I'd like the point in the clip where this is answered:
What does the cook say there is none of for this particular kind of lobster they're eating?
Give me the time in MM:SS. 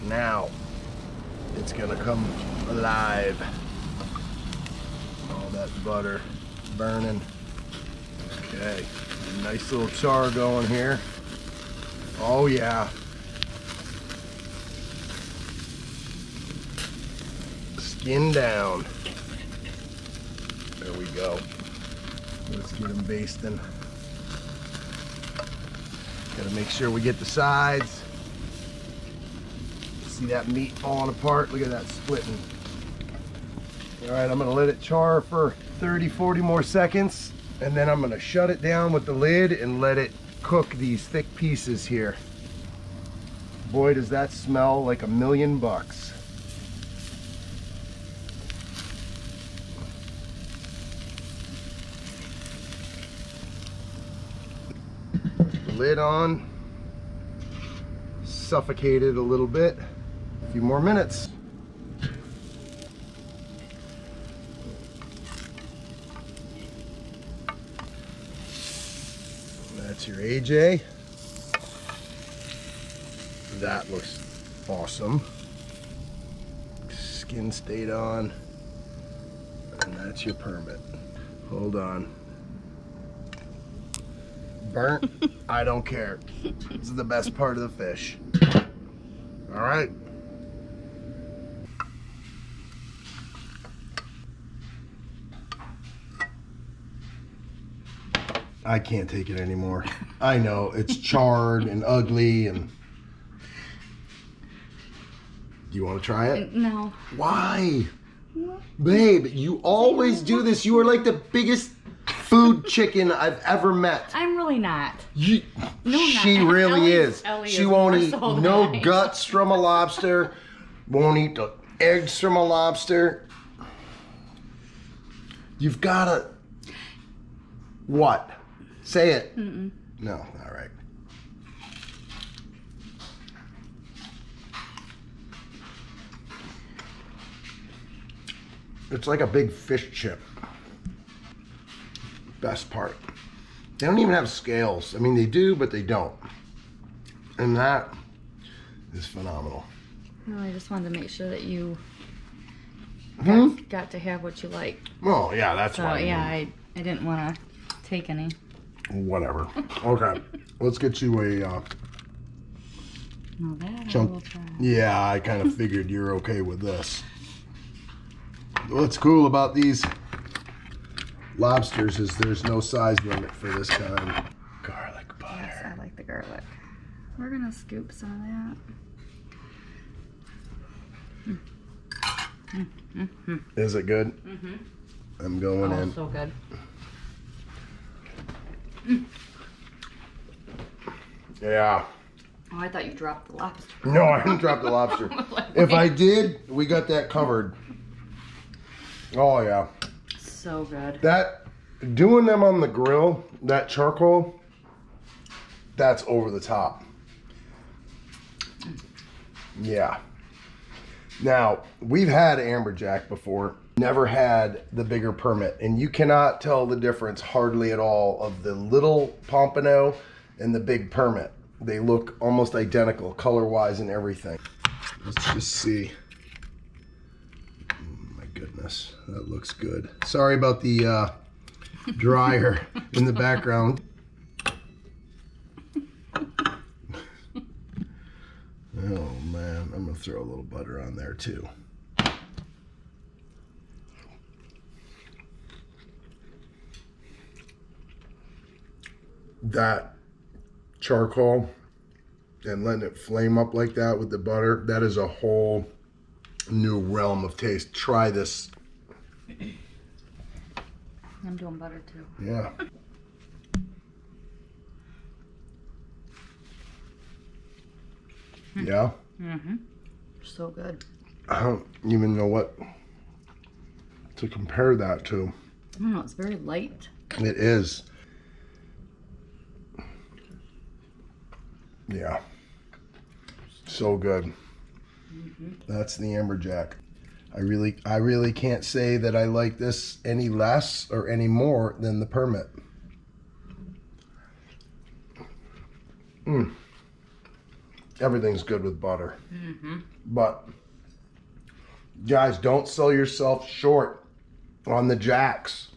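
02:52.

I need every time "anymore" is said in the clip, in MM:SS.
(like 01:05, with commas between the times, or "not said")
01:39.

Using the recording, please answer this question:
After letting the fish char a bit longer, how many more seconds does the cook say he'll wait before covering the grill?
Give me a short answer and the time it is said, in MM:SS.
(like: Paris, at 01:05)
30 to 40, at 00:35.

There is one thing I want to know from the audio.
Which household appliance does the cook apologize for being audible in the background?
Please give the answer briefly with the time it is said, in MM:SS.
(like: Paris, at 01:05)
dryer, at 03:51.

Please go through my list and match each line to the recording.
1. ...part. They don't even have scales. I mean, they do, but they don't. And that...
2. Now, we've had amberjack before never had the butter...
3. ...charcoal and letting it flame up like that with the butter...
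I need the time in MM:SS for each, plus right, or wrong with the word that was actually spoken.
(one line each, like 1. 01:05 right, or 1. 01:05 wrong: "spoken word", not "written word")
1. 02:22 right
2. 03:31 wrong: "bigger", not "butter"
3. 04:10 right.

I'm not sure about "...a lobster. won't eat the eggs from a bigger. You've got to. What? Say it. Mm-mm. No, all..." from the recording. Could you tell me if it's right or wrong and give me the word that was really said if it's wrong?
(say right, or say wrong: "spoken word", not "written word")
wrong: "lobster", not "bigger".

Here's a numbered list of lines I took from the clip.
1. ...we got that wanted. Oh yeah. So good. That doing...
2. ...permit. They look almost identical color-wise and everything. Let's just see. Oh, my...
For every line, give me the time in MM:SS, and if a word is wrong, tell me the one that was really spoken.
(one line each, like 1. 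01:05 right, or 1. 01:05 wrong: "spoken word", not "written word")
1. 03:16 wrong: "covered", not "wanted"
2. 03:40 right.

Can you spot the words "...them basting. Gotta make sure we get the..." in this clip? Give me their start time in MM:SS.
00:22.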